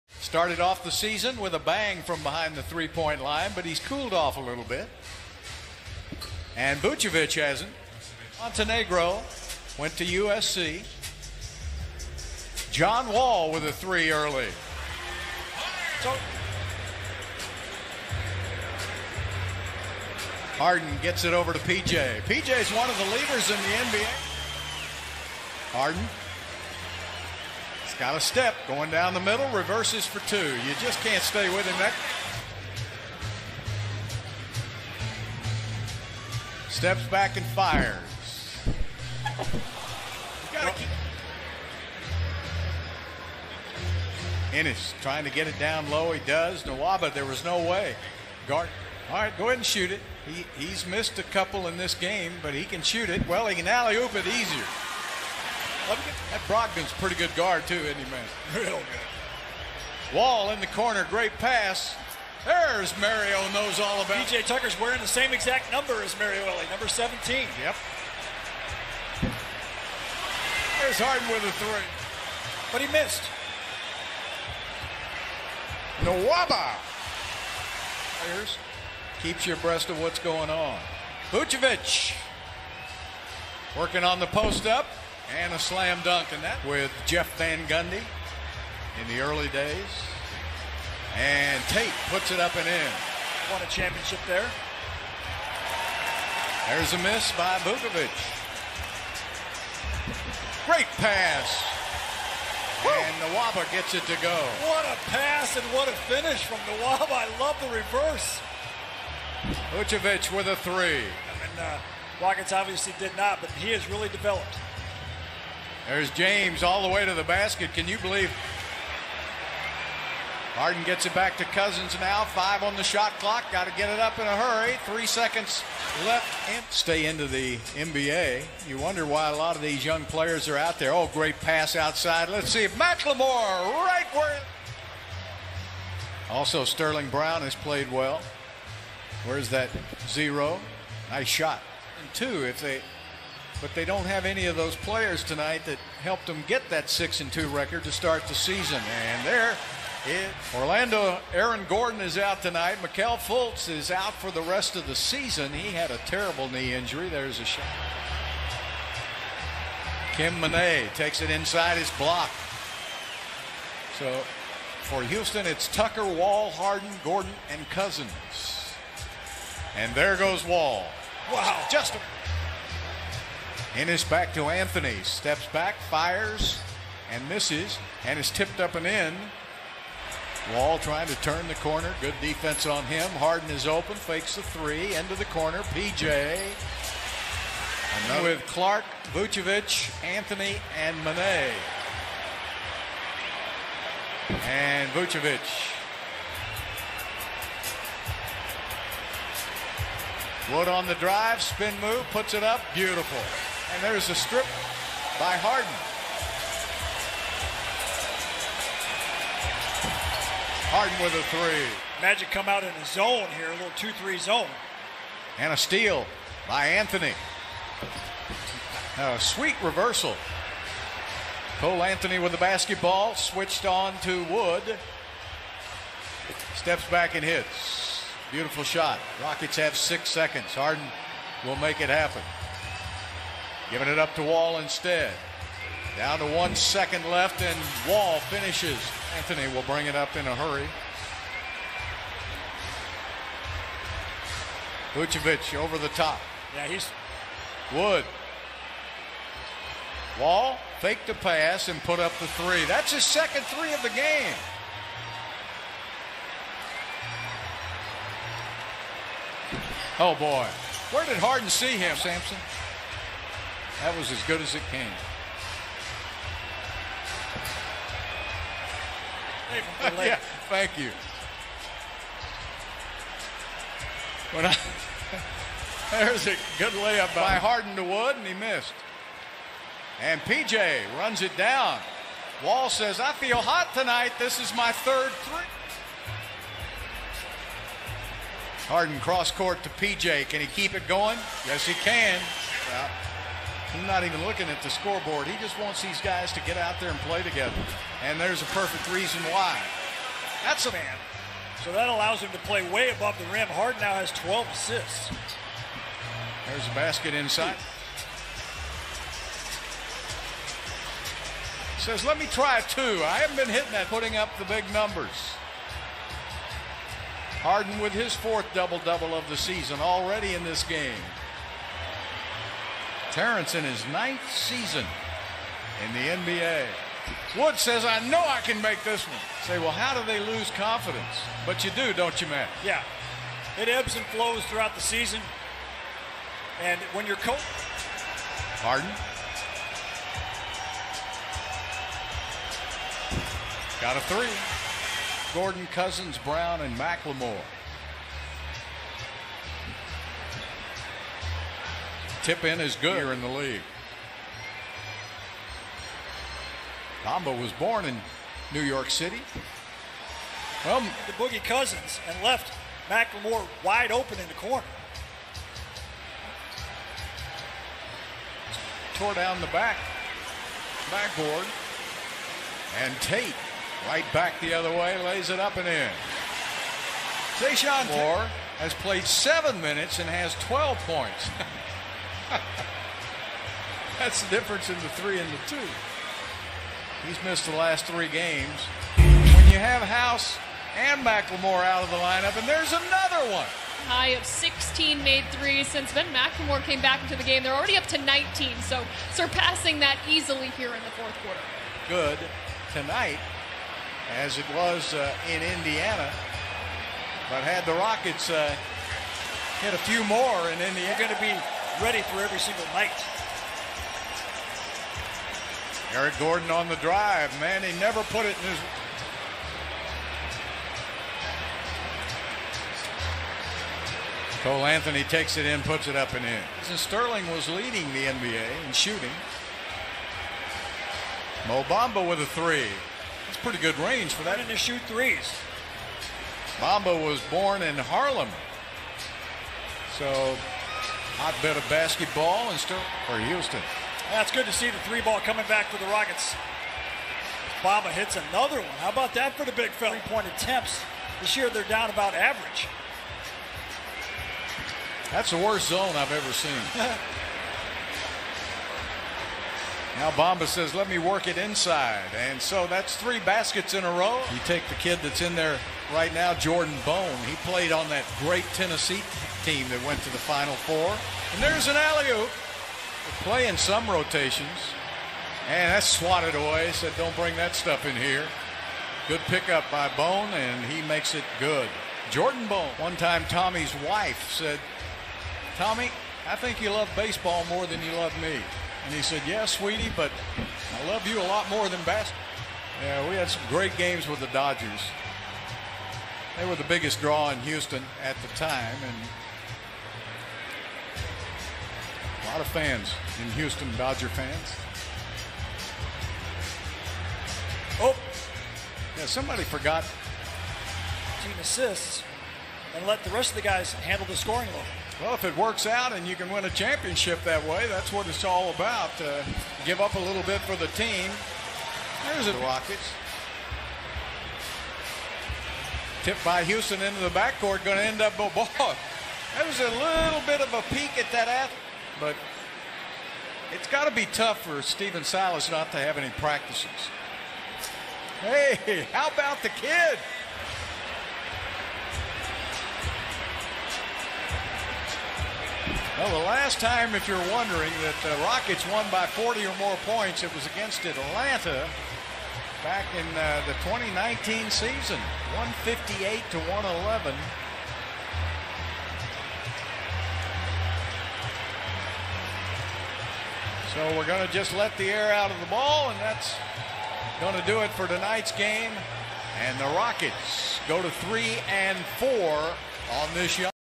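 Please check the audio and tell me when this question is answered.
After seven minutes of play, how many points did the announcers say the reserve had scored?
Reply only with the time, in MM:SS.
06:20.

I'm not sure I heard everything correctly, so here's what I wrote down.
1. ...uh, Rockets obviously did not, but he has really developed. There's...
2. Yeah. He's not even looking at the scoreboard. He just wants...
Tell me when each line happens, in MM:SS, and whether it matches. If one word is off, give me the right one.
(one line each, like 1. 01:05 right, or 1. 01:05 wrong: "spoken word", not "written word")
1. 01:51 right
2. 04:52 right.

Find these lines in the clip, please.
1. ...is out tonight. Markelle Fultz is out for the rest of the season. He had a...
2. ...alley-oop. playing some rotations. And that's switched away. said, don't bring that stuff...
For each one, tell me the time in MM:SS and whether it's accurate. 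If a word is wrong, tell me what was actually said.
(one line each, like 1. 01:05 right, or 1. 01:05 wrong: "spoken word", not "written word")
1. 02:32 right
2. 07:51 wrong: "swatted", not "switched".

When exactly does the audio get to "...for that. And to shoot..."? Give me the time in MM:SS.
07:14.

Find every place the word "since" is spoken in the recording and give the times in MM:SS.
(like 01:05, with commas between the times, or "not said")
06:35.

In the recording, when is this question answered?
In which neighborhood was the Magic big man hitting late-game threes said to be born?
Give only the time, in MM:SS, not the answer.
07:17.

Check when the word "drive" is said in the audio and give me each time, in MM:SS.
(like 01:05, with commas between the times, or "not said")
03:20, 06:56.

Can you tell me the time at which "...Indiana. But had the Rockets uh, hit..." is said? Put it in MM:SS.
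06:45.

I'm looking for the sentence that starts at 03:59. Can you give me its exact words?
Anthony will bring it up in a hurry.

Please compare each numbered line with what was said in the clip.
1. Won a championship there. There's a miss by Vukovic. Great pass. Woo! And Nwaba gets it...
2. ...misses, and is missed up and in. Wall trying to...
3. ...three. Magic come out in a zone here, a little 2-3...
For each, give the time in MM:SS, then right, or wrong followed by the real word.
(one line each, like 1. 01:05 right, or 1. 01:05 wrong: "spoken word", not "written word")
1. 01:33 right
2. 02:57 wrong: "tipped", not "missed"
3. 03:31 right.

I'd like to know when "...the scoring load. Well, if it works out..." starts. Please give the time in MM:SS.
08:34.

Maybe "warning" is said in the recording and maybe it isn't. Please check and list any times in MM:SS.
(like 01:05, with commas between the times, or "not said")
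not said.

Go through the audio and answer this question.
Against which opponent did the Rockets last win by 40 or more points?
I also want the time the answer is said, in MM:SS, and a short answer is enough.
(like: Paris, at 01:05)
Atlanta, at 09:10.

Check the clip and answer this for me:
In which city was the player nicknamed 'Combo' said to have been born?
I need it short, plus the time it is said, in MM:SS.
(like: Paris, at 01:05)
New York City, at 05:58.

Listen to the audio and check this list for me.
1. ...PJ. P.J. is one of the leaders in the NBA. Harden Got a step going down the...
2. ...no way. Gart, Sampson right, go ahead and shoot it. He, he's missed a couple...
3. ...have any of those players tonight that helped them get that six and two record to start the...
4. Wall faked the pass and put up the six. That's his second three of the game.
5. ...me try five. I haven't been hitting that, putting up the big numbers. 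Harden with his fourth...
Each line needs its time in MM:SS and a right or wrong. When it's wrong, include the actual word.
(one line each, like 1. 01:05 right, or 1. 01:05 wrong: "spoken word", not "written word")
1. 00:21 right
2. 00:47 wrong: "All", not "Sampson"
3. 02:24 right
4. 04:10 wrong: "three", not "six"
5. 05:12 wrong: "two", not "five".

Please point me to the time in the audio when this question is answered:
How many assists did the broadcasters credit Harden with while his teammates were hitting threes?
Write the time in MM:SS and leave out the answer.
05:04.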